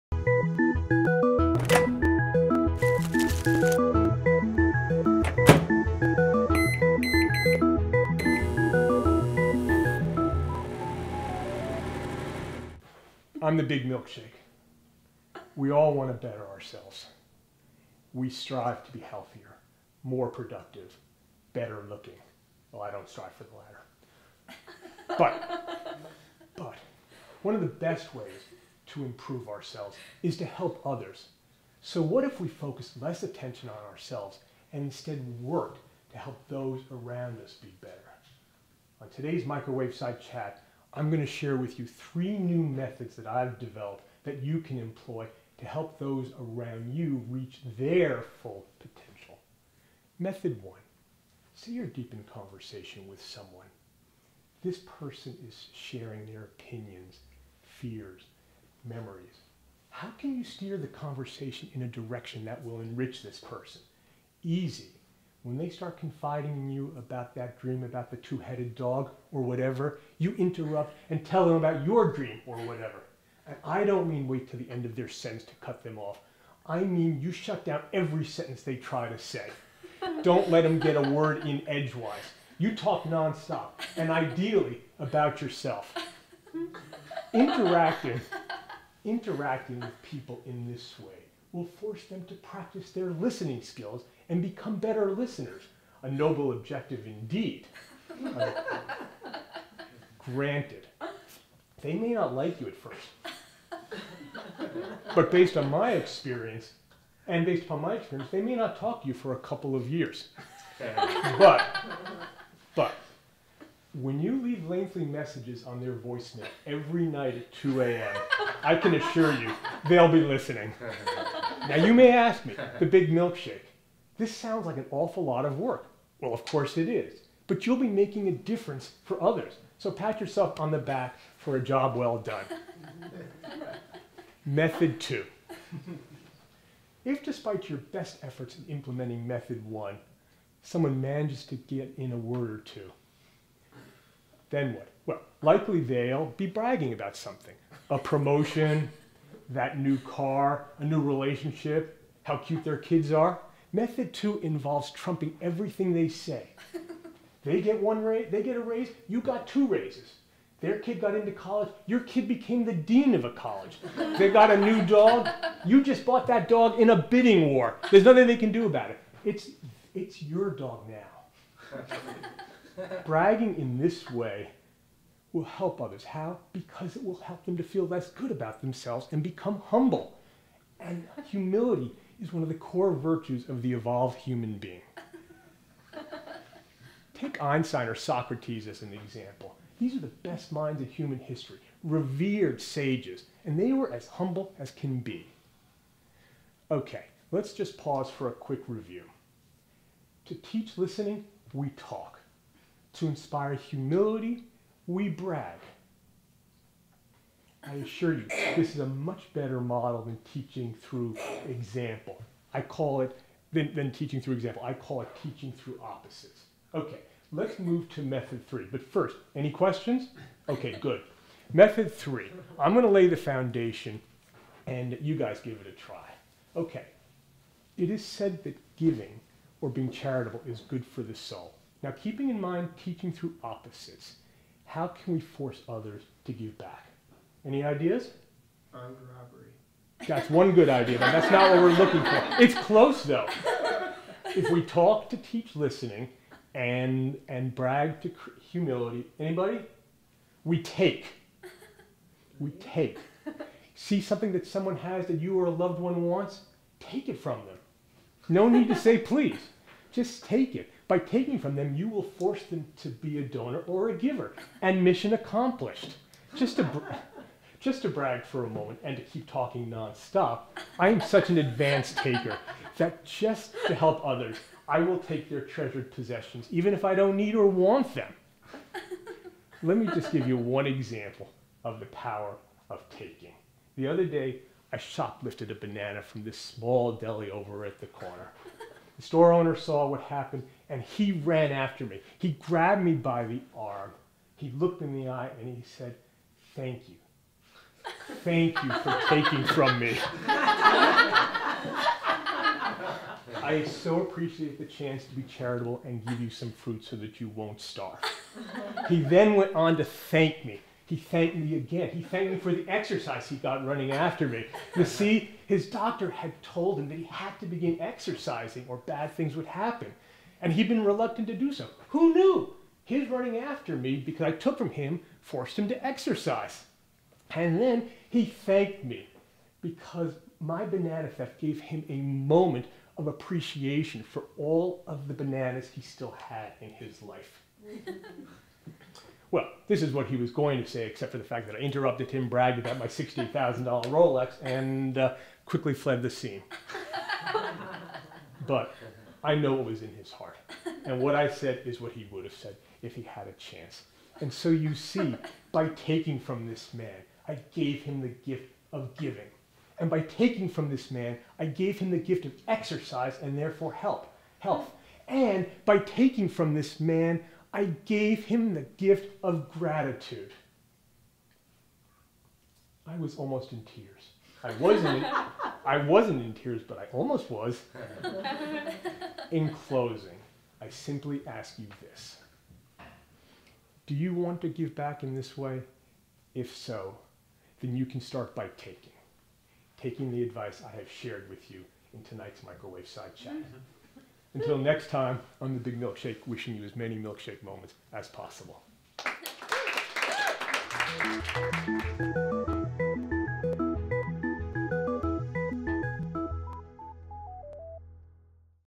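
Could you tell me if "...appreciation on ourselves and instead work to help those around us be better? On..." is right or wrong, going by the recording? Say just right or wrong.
wrong.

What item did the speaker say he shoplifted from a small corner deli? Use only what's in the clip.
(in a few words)
a banana.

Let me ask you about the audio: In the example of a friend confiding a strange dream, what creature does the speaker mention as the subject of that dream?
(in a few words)
two headed dog.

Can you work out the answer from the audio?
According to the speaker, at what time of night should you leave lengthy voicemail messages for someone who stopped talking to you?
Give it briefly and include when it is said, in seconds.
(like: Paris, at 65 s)
2 a.m., at 117 s.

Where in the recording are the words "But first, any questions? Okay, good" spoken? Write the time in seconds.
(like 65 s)
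218 s.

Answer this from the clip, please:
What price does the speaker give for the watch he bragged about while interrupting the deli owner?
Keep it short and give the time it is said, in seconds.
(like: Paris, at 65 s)
$60, at 342 s.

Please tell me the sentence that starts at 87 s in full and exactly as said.
Interacting, interacting with people in this way will force them to practice their listening skills and become better listeners.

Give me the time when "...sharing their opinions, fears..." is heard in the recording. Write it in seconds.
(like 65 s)
55 s.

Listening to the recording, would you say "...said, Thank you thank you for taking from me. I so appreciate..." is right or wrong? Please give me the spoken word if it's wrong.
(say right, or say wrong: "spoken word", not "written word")
right.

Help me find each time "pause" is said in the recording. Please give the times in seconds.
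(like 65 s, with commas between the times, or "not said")
197 s.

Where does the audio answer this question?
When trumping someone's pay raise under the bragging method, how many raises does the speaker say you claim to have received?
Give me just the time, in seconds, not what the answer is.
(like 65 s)
159 s.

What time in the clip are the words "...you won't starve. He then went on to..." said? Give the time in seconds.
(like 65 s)
307 s.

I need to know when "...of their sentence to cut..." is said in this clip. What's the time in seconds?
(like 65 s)
74 s.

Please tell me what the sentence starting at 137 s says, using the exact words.
If despite your best efforts in implementing method one, someone manages to get in a word or two, then what?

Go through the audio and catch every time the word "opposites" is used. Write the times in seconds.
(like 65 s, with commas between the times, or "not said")
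215 s, 233 s.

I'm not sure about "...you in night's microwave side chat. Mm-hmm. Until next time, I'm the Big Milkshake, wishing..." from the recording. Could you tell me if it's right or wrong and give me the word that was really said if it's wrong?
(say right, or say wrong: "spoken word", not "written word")
wrong: "tonight", not "night".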